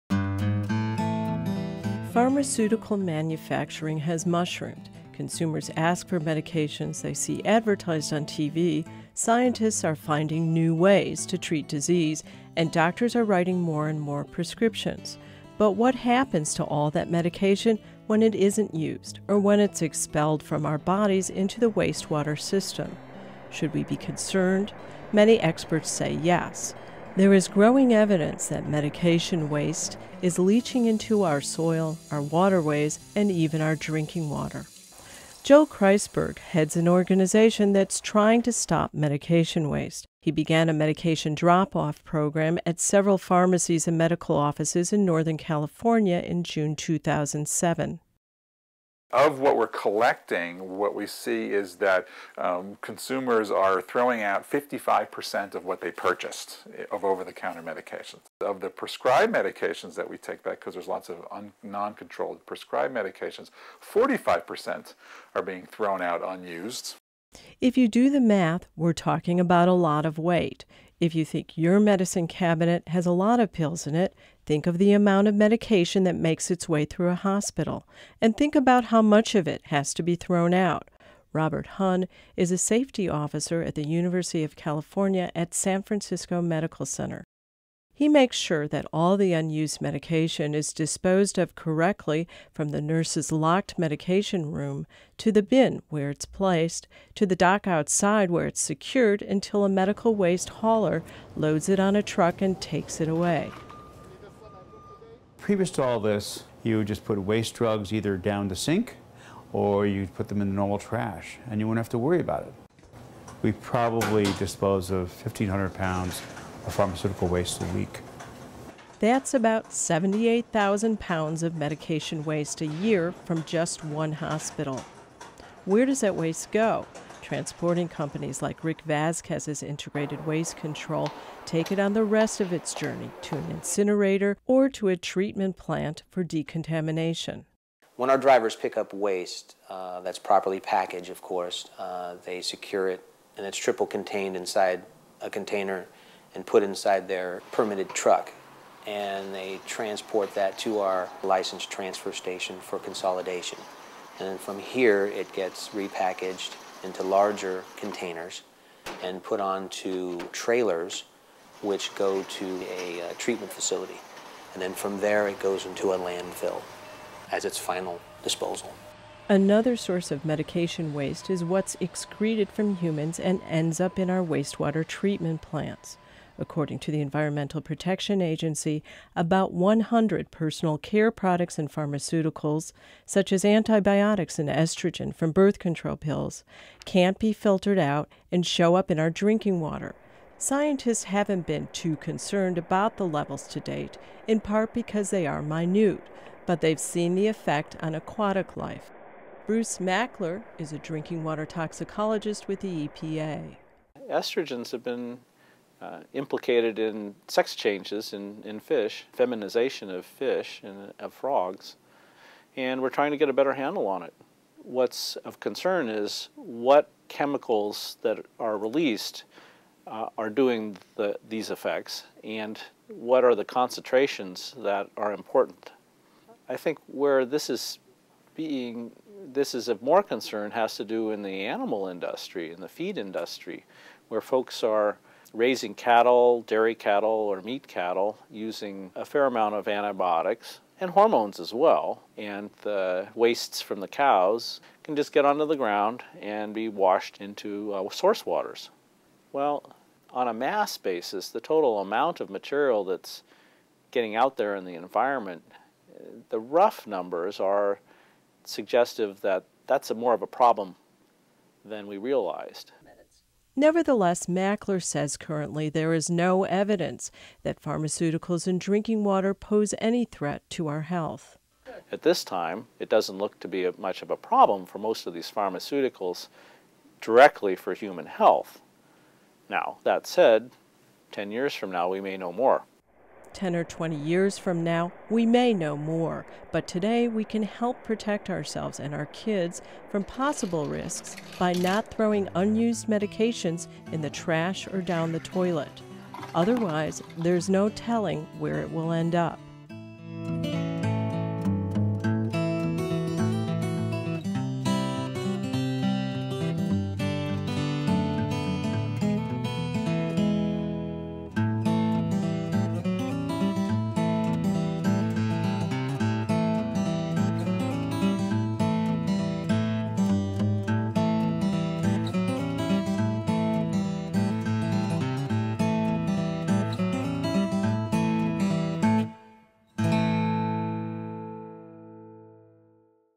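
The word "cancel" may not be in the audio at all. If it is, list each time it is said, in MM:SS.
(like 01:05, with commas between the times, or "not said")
not said.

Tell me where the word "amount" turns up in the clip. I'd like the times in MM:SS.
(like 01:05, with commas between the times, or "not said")
01:14, 03:59, 04:11.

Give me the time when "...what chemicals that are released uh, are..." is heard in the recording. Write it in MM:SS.
03:36.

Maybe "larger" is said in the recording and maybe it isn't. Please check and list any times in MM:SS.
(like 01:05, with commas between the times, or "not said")
02:37.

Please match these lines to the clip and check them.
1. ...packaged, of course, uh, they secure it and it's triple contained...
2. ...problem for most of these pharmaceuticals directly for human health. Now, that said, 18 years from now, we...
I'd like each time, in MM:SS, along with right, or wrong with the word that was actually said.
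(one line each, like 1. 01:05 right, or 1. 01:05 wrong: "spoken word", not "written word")
1. 02:20 right
2. 04:34 wrong: "10", not "18".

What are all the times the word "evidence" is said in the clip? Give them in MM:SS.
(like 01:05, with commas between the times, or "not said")
00:27, 04:26.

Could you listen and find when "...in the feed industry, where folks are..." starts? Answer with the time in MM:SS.
03:52.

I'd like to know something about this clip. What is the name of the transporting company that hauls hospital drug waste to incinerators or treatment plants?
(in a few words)
Integrated Waste Control.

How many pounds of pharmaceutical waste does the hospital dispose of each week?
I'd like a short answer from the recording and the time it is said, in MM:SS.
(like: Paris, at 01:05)
1,500 pounds, at 01:55.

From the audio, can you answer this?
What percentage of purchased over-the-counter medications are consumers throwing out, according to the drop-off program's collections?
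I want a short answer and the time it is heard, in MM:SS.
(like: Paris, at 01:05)
55%, at 00:54.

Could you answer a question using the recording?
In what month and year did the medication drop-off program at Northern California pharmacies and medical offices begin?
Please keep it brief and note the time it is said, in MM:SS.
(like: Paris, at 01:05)
June 2007, at 00:46.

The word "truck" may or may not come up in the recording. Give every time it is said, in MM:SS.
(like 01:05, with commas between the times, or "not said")
01:42, 02:27.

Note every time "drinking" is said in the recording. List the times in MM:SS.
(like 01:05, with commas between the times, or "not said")
00:33, 03:09, 03:20, 04:28.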